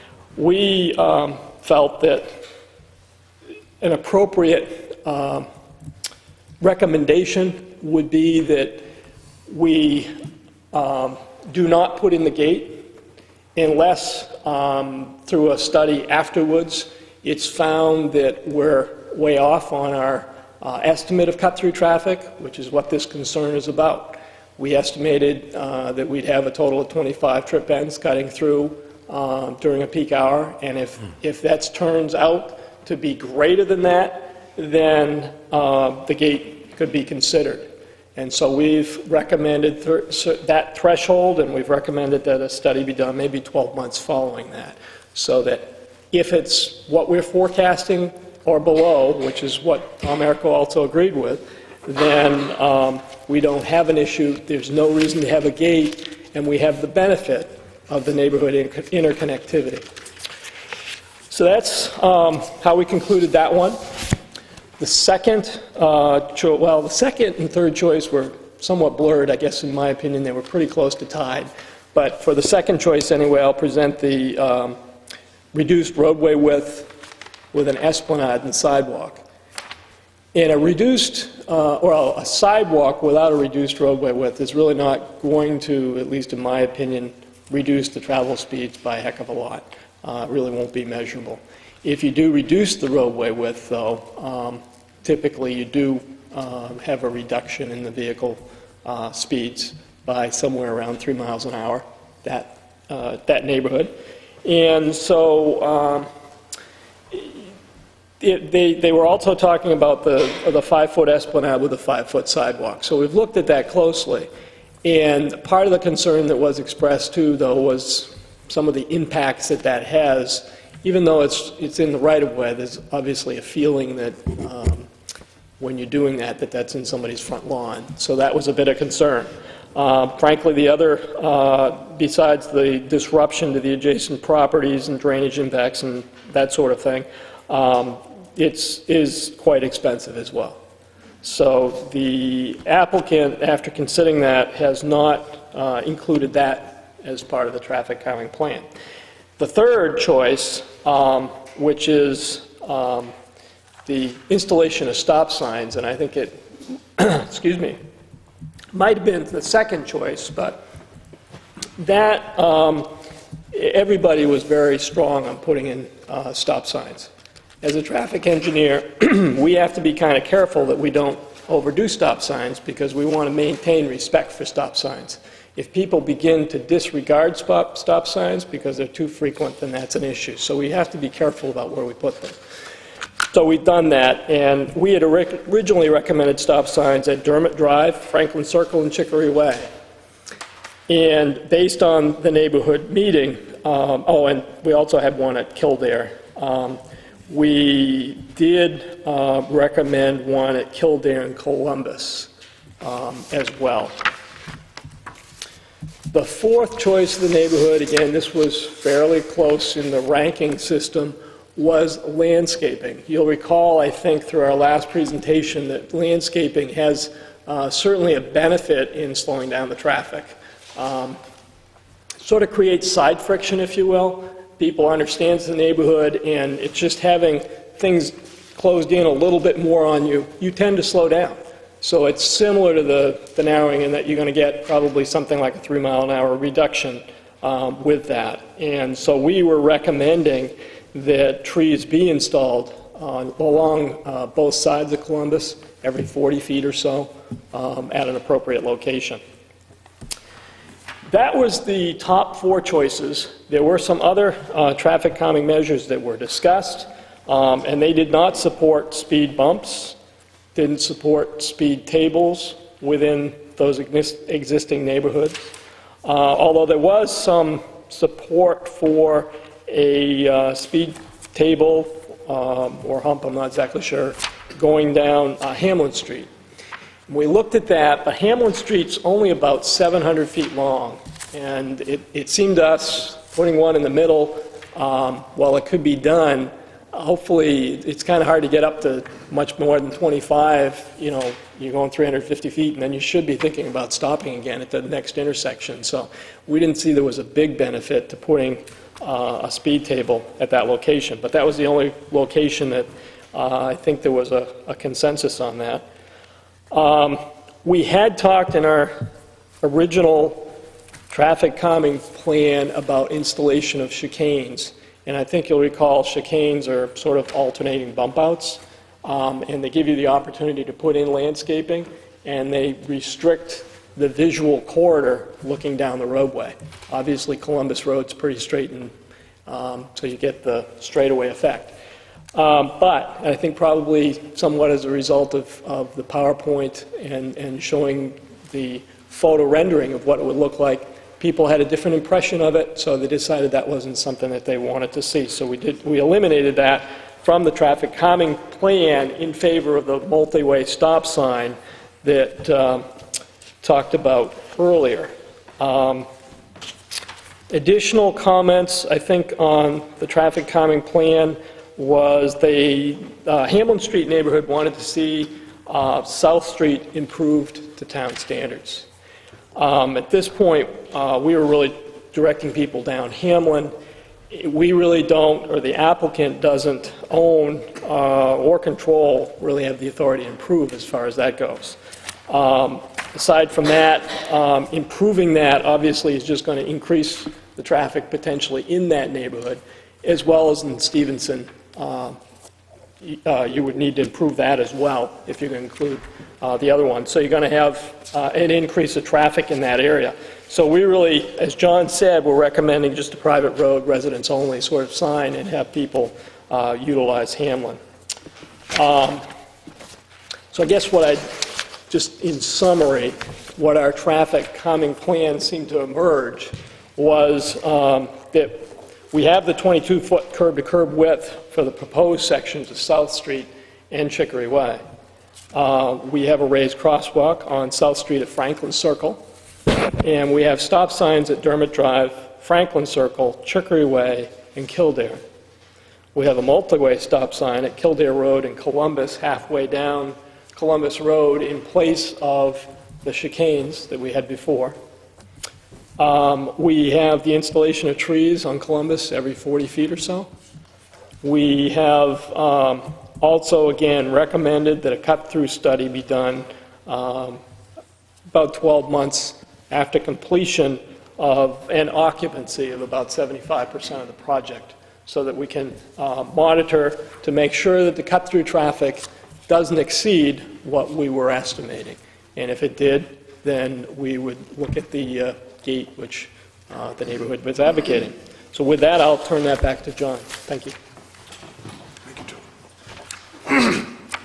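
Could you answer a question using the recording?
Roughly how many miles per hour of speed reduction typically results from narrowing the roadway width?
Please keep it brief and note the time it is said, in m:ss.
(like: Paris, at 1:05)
3, at 1:40.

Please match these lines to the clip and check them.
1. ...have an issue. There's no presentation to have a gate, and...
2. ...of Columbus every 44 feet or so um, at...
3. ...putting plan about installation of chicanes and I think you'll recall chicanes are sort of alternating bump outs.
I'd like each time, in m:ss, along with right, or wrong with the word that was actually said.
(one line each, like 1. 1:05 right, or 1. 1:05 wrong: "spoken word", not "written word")
1. 0:53 wrong: "reason", not "presentation"
2. 4:04 wrong: "40", not "44"
3. 5:11 wrong: "calming", not "putting".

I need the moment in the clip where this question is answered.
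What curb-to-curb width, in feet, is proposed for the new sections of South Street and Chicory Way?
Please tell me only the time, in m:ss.
6:59.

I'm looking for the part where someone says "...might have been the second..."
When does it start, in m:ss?
2:38.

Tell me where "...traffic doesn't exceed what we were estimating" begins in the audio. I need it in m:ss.
7:48.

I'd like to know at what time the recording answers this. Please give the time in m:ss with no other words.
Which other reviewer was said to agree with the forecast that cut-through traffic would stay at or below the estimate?
0:50.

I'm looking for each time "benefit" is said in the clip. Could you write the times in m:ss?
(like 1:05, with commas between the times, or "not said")
0:57, 3:38, 4:57.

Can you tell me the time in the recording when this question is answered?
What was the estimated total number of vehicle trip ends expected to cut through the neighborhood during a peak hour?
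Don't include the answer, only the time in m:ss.
0:26.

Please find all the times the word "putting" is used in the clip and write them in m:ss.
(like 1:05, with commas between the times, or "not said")
2:45, 4:43, 4:58.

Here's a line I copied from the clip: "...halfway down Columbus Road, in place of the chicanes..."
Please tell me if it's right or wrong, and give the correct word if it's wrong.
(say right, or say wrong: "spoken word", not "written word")
right.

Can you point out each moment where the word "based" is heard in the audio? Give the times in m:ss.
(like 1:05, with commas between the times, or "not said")
3:11.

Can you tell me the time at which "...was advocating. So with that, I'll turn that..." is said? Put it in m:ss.
7:57.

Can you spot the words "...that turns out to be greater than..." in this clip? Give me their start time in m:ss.
0:31.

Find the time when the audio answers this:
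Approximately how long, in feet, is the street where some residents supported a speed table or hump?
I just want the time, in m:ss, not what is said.
4:39.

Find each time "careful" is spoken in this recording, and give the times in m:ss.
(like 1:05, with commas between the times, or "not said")
2:50, 3:01.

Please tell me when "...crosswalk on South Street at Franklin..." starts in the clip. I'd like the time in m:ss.
7:06.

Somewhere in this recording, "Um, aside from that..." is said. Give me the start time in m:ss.
6:22.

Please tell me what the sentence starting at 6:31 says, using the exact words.
Uh, uh you would need to improve that as well if you're going to include uh, the other one.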